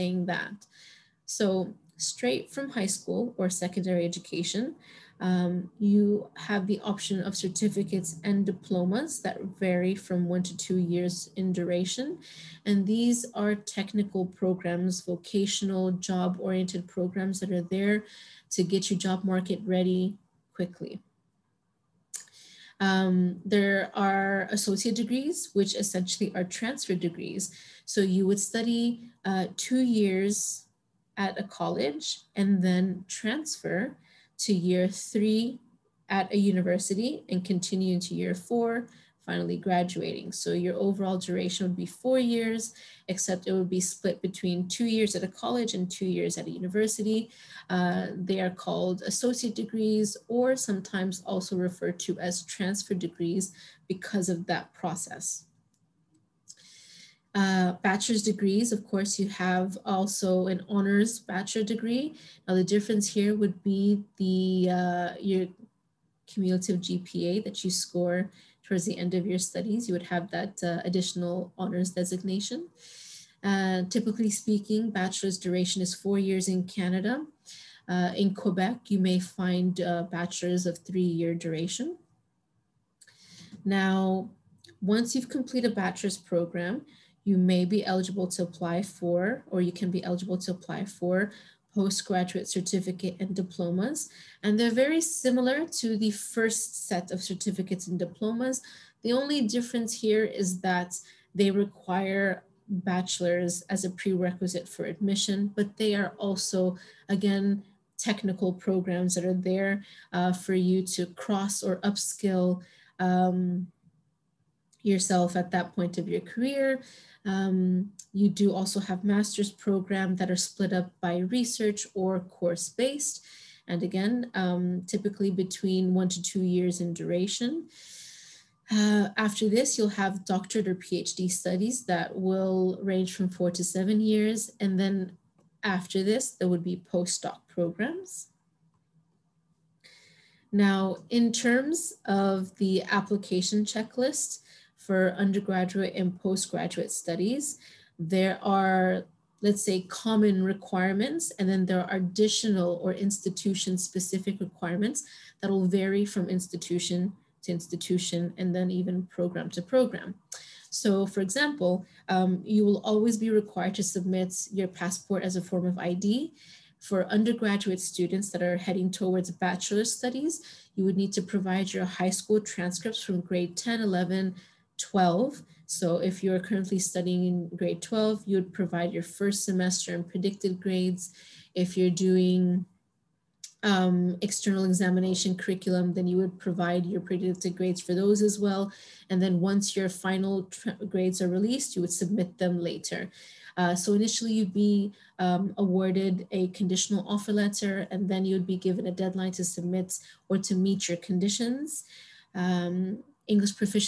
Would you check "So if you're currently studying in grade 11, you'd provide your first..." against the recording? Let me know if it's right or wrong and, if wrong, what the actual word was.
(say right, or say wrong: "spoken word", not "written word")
wrong: "12", not "11".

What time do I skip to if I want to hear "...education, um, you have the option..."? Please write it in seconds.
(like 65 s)
4 s.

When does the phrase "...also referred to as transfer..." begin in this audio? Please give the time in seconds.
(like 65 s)
51 s.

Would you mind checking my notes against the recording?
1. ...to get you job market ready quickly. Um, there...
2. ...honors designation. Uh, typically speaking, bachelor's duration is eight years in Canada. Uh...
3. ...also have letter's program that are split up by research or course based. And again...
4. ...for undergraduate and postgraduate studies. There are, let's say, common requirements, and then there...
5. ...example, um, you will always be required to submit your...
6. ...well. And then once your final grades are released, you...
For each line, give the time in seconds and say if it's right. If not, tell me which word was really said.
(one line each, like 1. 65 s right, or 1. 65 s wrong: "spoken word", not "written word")
1. 18 s right
2. 71 s wrong: "four", not "eight"
3. 118 s wrong: "master", not "letter"
4. 144 s right
5. 161 s right
6. 188 s right.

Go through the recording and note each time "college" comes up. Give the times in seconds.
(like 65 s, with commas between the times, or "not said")
31 s, 45 s.